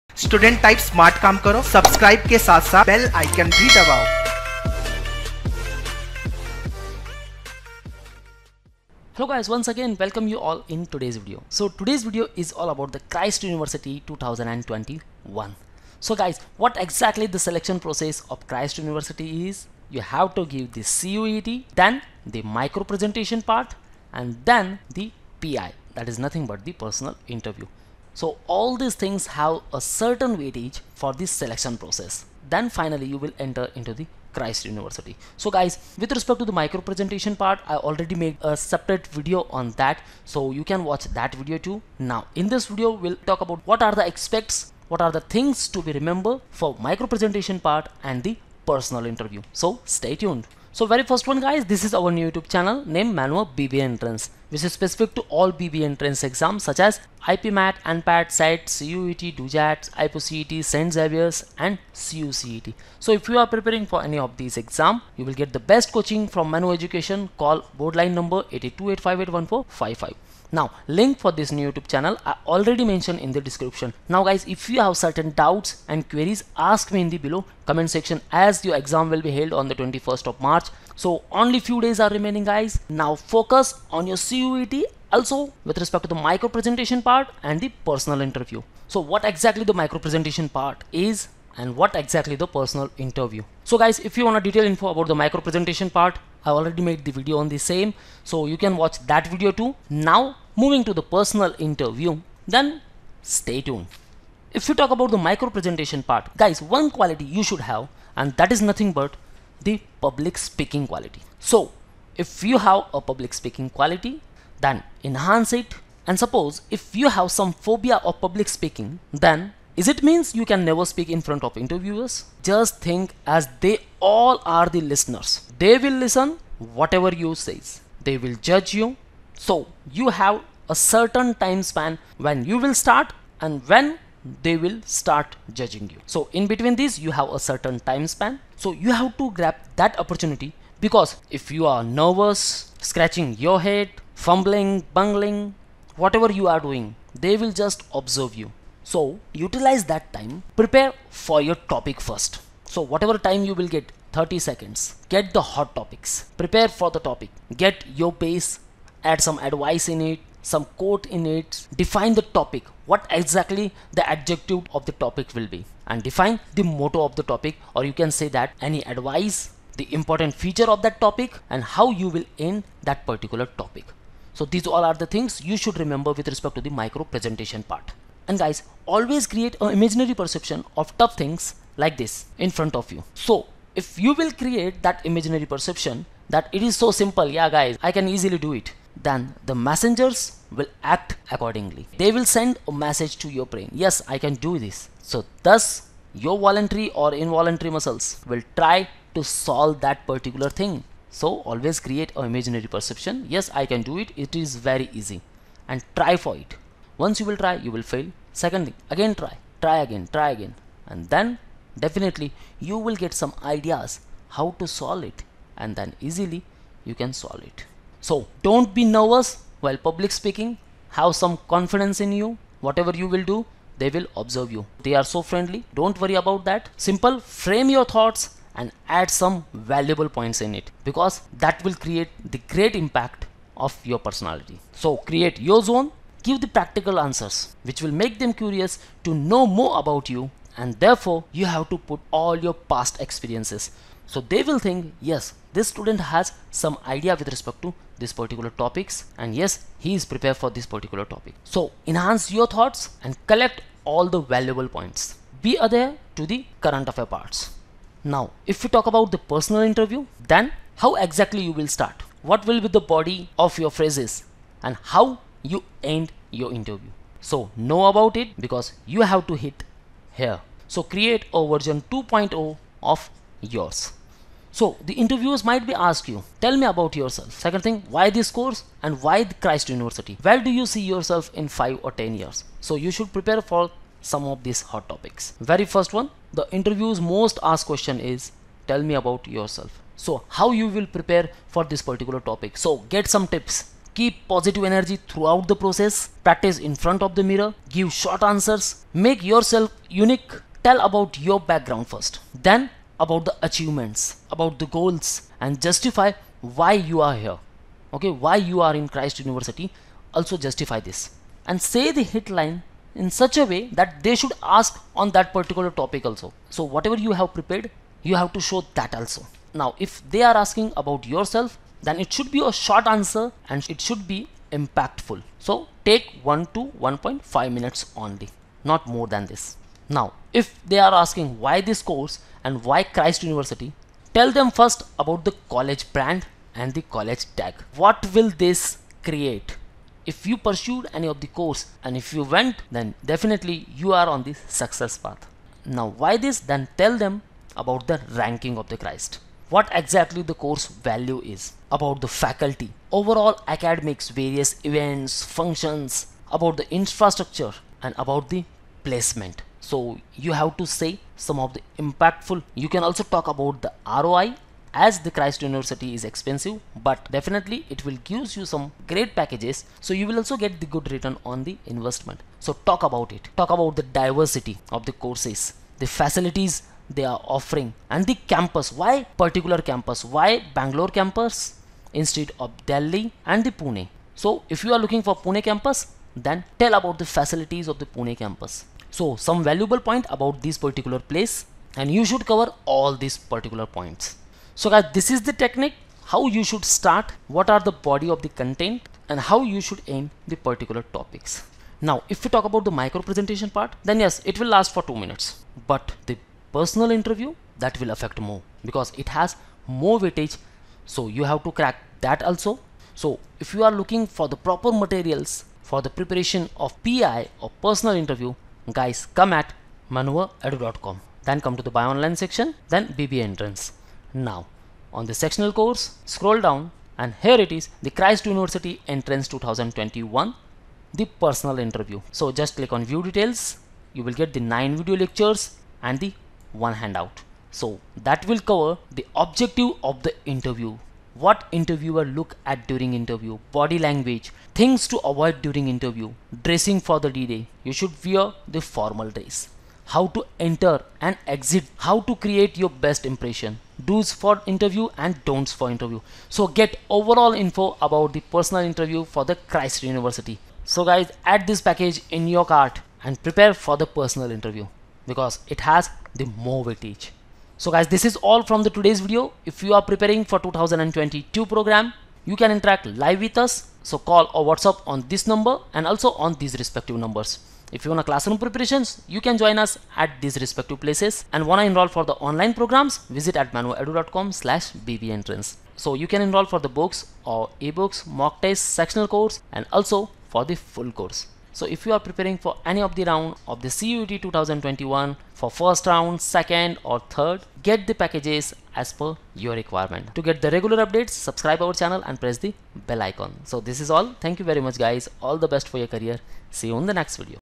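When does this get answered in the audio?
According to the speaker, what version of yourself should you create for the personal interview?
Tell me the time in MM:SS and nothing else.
04:31.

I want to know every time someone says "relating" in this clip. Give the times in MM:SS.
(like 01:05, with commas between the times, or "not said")
not said.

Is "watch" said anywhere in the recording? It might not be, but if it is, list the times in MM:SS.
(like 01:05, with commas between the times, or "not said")
00:40, 01:38.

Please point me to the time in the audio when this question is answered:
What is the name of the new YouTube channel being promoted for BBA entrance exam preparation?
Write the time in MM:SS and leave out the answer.
00:53.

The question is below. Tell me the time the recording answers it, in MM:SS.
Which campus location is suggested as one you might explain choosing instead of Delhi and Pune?
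06:20.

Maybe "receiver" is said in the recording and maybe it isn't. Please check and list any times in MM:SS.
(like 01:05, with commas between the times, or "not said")
not said.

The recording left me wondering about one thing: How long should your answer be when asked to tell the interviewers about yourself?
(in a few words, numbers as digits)
1 to 1.5 minutes.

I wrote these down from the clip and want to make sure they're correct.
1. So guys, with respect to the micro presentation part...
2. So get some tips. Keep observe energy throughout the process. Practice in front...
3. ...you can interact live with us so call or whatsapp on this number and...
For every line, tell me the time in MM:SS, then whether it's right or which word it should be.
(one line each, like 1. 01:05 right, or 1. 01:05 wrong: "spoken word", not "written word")
1. 00:35 right
2. 04:52 wrong: "positive", not "observe"
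3. 07:52 right.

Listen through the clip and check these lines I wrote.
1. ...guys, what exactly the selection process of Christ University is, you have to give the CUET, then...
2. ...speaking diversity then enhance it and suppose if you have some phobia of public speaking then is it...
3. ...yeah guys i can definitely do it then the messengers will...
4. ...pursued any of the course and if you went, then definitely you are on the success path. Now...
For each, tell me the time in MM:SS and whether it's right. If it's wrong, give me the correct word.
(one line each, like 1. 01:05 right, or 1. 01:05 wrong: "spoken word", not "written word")
1. 00:16 right
2. 01:53 wrong: "quality", not "diversity"
3. 03:07 wrong: "easily", not "definitely"
4. 05:40 right.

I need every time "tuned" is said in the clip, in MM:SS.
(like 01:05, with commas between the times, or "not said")
00:50, 01:43.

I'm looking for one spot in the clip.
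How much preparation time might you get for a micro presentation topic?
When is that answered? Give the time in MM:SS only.
02:34.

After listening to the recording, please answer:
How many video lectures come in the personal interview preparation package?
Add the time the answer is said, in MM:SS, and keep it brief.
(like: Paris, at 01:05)
9, at 07:14.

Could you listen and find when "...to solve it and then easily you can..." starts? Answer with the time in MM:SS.
03:34.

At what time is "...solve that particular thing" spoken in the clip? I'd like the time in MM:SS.
03:19.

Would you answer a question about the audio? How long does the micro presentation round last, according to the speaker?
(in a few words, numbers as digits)
two minutes.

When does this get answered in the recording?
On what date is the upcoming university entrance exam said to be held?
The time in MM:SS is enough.
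01:19.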